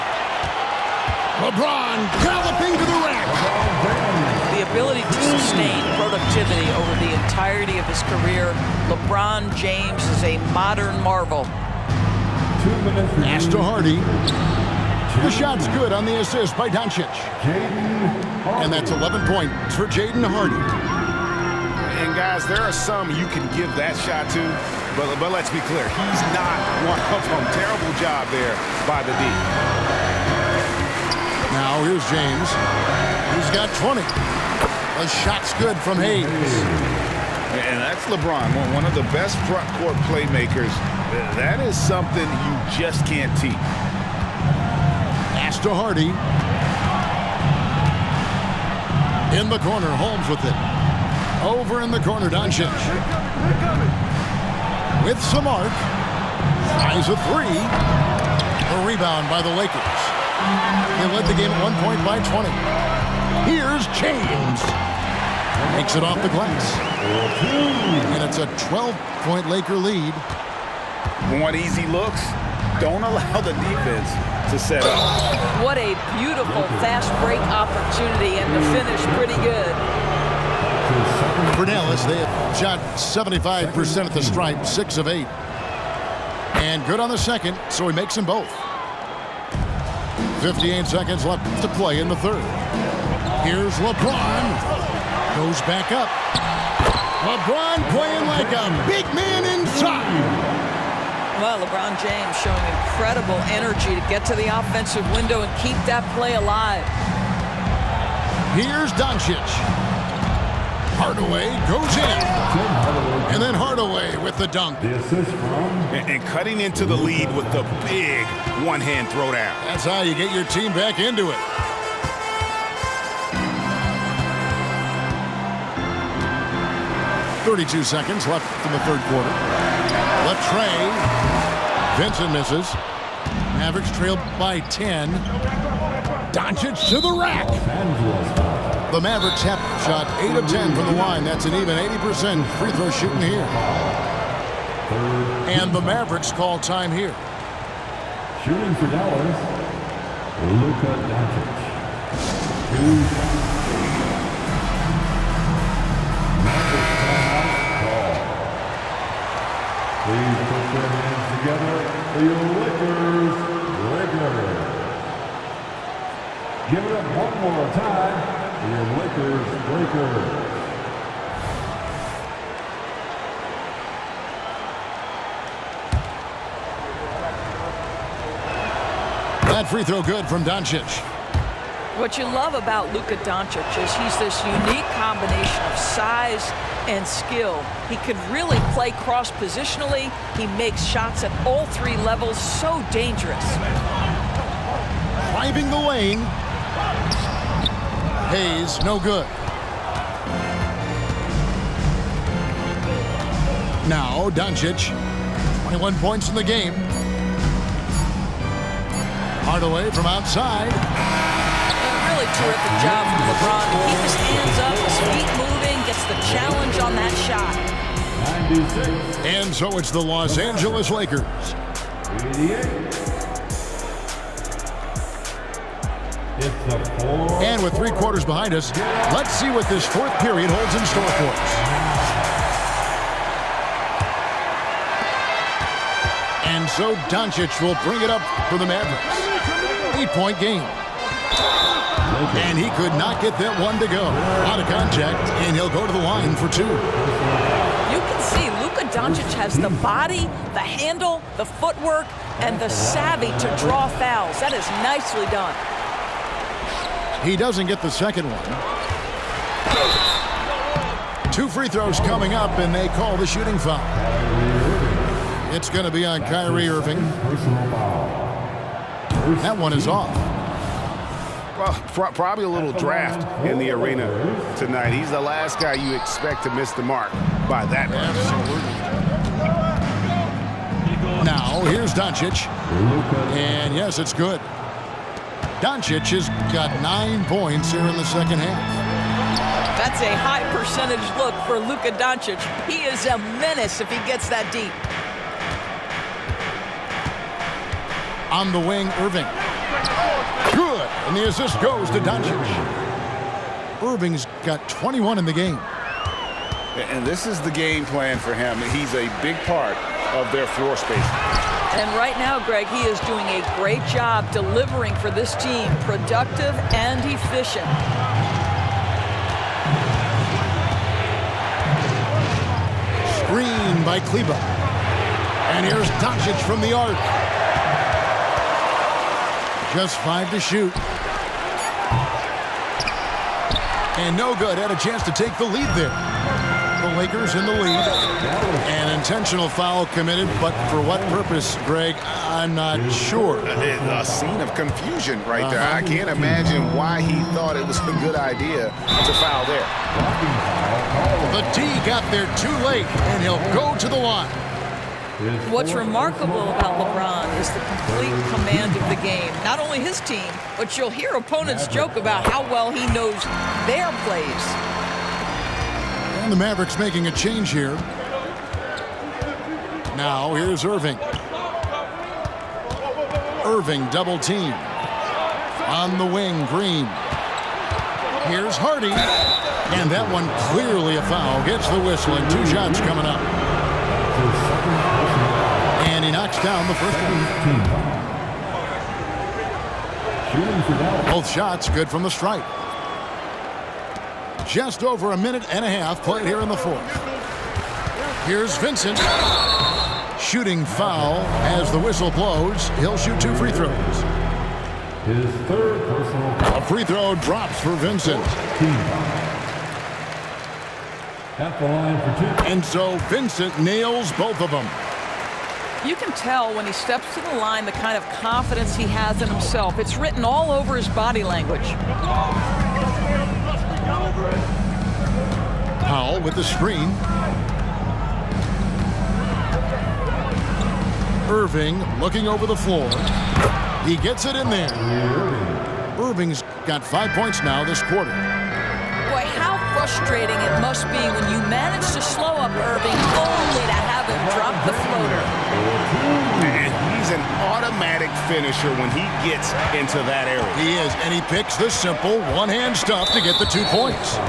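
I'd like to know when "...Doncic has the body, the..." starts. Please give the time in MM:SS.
04:08.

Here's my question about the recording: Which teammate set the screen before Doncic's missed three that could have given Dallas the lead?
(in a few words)
Kleber.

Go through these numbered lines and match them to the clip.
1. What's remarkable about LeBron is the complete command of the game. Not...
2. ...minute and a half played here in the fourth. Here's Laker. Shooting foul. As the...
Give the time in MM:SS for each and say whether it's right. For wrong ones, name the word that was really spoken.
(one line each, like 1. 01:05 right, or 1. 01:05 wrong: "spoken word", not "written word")
1. 05:55 right
2. 06:35 wrong: "Vincent", not "Laker".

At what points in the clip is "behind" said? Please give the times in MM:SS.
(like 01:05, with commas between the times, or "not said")
03:48.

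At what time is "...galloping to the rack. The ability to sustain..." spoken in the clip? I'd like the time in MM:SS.
00:02.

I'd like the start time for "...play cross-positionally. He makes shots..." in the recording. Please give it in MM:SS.
03:08.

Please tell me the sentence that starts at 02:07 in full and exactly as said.
Thirty-two seconds left in the third quarter.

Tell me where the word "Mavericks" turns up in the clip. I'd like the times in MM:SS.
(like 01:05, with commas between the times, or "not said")
02:13, 02:18, 02:25, 03:58, 06:06.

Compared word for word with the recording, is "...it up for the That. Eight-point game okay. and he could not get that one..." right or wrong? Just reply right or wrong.
wrong.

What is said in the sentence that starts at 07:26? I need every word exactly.
he's an automatic finisher when he gets into that area.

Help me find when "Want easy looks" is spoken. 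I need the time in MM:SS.
01:11.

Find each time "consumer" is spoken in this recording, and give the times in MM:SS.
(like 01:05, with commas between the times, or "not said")
not said.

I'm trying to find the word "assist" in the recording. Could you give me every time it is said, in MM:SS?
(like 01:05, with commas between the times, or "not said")
00:16, 05:01.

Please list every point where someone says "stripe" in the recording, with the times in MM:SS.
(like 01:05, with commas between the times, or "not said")
01:24, 06:32.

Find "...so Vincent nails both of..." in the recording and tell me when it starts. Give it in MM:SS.
06:52.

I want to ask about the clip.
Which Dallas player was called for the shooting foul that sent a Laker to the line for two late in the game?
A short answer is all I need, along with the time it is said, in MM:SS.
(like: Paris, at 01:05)
Kyrie Irving, at 04:26.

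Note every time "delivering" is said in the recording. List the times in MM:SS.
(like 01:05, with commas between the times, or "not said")
05:14.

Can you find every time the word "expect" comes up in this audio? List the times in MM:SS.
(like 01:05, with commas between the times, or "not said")
04:35.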